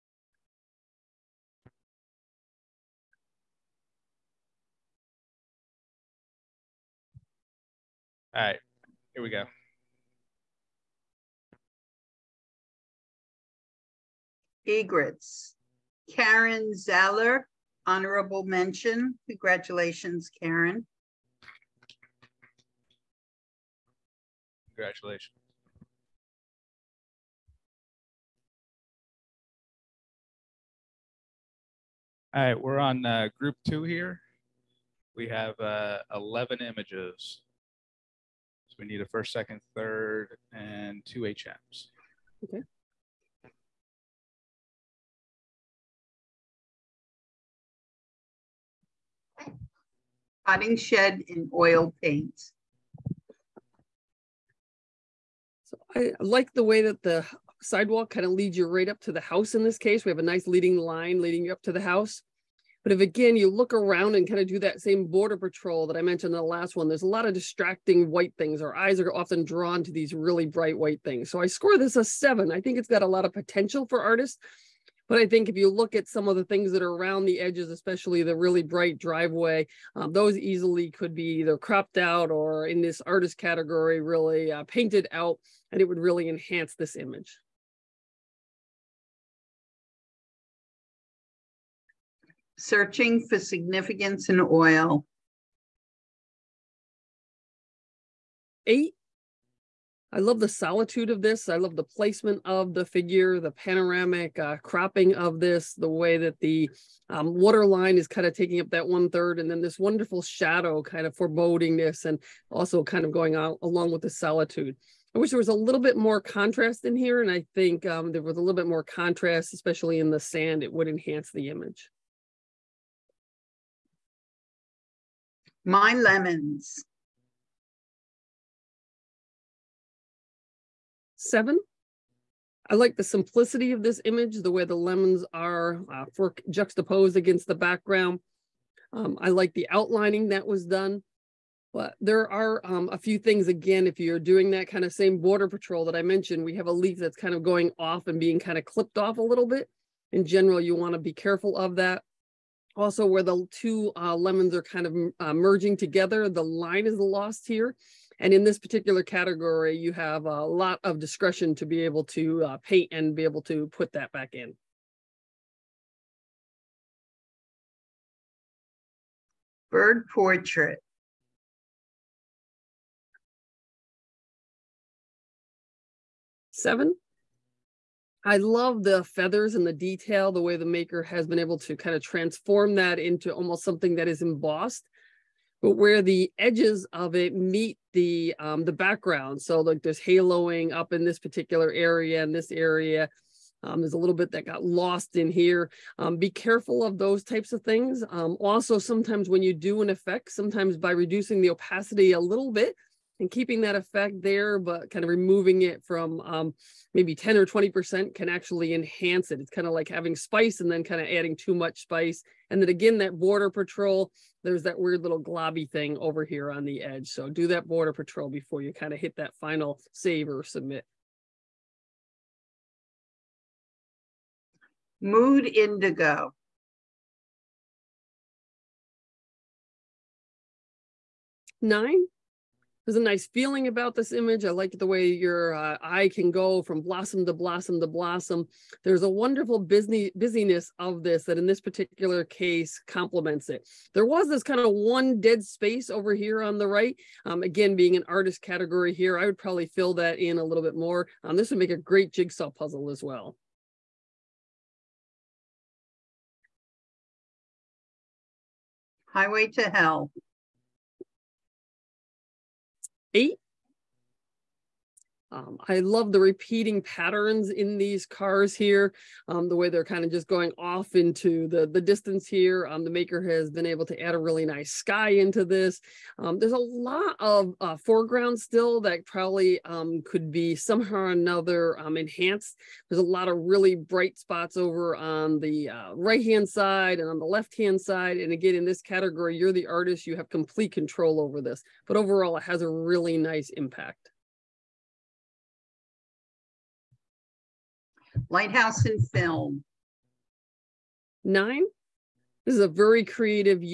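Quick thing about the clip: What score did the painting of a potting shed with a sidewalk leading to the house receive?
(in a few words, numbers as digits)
7.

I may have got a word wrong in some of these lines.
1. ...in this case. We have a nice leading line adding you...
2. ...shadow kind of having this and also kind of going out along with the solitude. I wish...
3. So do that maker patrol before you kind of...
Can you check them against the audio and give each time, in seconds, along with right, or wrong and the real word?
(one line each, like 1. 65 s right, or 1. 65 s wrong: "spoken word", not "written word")
1. 59 s wrong: "leading", not "adding"
2. 110 s wrong: "foreboding", not "having"
3. 217 s wrong: "border", not "maker".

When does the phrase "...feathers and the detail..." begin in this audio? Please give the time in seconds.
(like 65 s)
179 s.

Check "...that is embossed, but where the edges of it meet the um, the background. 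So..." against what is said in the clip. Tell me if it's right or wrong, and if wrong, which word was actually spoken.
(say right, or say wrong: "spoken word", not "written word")
right.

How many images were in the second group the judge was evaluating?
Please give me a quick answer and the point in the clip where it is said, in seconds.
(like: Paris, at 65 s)
11, at 36 s.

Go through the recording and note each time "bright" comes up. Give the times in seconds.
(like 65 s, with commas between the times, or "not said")
70 s, 78 s, 283 s.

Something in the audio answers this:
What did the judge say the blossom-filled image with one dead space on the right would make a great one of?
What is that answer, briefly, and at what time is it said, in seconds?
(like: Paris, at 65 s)
Jigsaw puzzle, at 252 s.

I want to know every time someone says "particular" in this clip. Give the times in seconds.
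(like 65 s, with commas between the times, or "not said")
158 s, 191 s, 241 s.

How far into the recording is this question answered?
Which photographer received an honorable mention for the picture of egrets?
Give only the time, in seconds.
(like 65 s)
16 s.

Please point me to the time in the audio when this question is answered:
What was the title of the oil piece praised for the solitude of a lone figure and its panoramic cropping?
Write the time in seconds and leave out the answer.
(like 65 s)
92 s.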